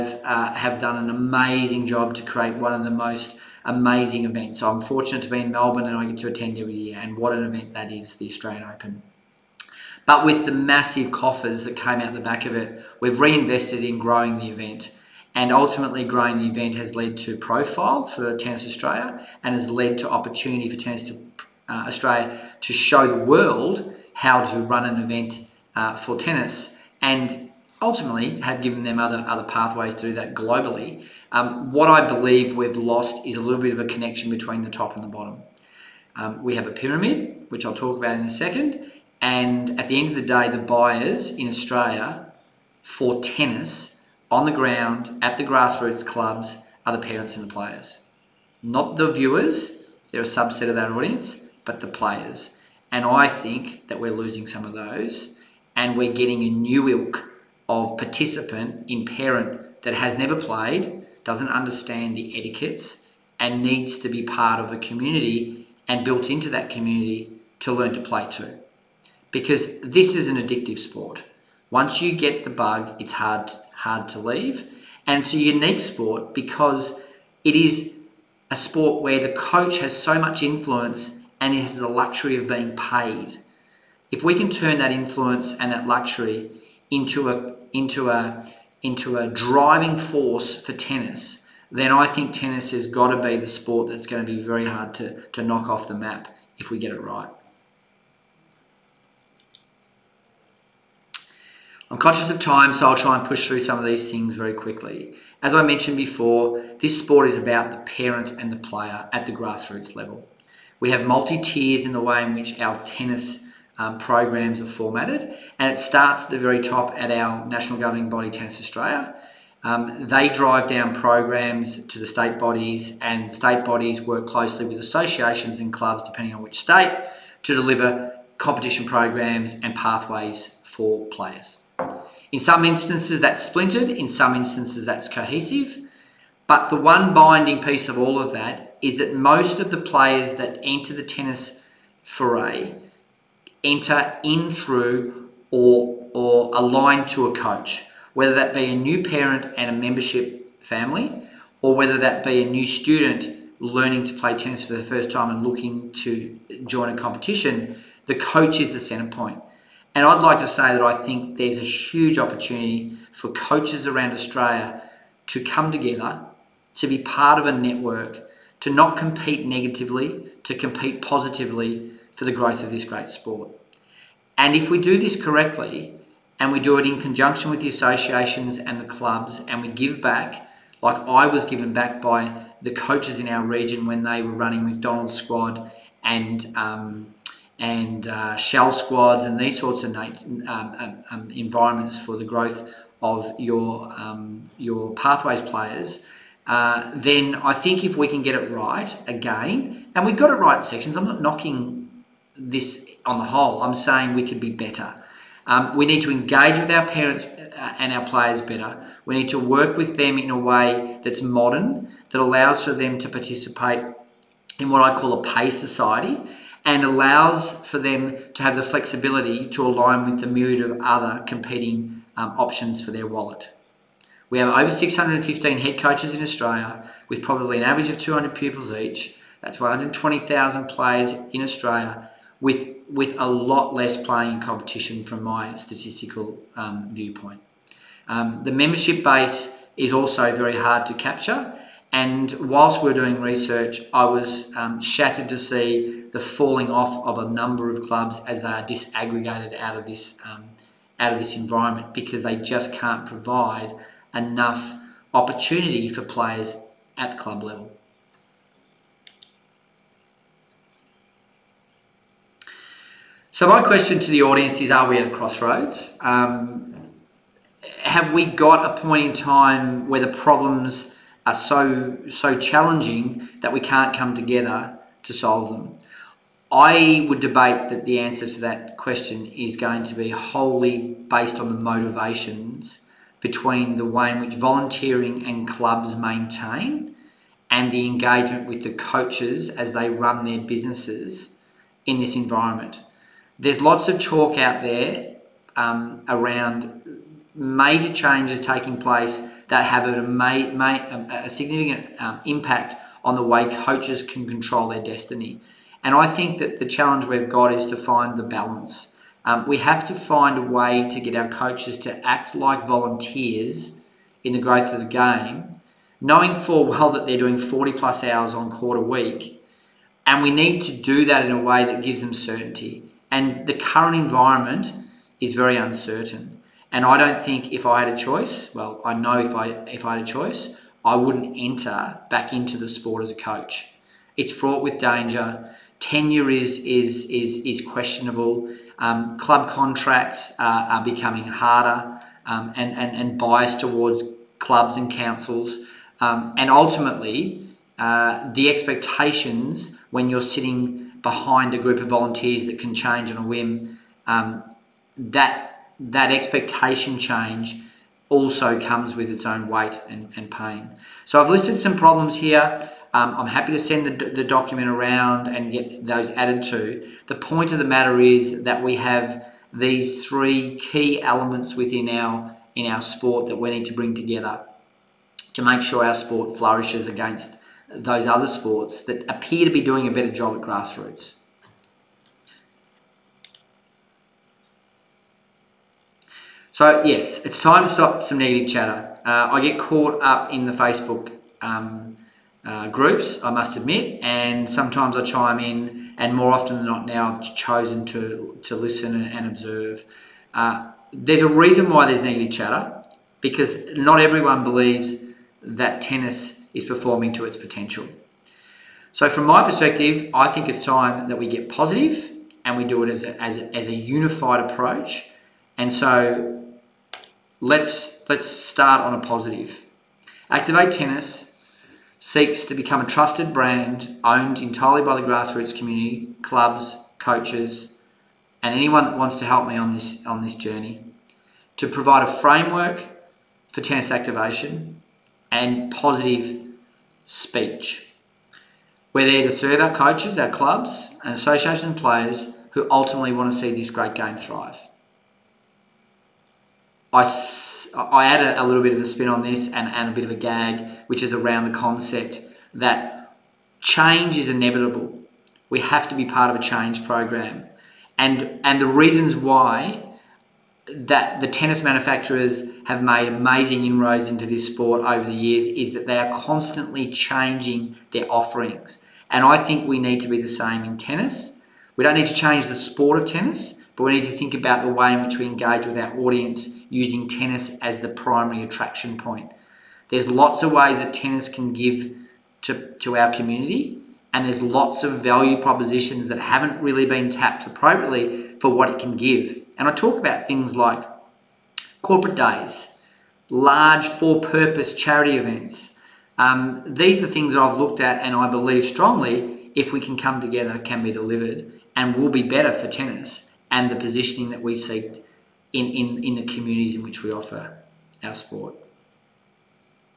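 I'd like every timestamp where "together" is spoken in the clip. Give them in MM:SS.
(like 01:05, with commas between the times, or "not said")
02:45, 04:34, 06:13, 08:20.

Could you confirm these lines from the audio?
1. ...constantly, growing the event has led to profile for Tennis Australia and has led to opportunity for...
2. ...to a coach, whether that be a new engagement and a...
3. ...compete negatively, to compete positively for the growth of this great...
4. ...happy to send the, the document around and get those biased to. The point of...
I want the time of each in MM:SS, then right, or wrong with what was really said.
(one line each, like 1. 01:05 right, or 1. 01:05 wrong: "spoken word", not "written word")
1. 00:15 wrong: "ultimately", not "constantly"
2. 02:27 wrong: "parent", not "engagement"
3. 02:48 right
4. 06:03 wrong: "added", not "biased".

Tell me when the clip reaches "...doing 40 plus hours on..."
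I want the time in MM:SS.
05:17.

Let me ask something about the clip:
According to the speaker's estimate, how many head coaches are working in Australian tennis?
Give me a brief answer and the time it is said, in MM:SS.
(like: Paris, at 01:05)
615, at 03:44.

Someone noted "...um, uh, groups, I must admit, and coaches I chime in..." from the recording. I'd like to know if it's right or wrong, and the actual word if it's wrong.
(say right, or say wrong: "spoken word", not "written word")
wrong: "sometimes", not "coaches".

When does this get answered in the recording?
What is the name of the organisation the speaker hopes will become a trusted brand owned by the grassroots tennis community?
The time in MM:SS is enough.
07:00.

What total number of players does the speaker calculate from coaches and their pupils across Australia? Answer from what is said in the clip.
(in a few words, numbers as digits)
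120,000.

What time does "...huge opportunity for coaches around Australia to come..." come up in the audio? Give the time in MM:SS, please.
02:41.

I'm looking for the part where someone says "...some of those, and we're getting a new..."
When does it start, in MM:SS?
00:54.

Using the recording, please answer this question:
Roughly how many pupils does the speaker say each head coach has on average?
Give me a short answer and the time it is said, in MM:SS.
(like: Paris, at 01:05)
200, at 03:47.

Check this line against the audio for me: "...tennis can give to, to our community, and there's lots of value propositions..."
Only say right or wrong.
right.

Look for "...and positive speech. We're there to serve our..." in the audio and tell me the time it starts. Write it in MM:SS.
07:15.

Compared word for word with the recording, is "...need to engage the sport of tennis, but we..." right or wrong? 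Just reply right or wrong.
wrong.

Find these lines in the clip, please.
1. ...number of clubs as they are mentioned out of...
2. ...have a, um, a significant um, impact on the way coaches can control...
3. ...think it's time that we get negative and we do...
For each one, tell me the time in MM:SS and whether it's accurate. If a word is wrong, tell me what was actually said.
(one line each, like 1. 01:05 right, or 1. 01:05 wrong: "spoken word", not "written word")
1. 04:07 wrong: "disaggregated", not "mentioned"
2. 04:59 right
3. 06:50 wrong: "positive", not "negative".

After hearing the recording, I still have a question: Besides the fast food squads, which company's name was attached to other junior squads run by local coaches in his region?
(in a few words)
Shell.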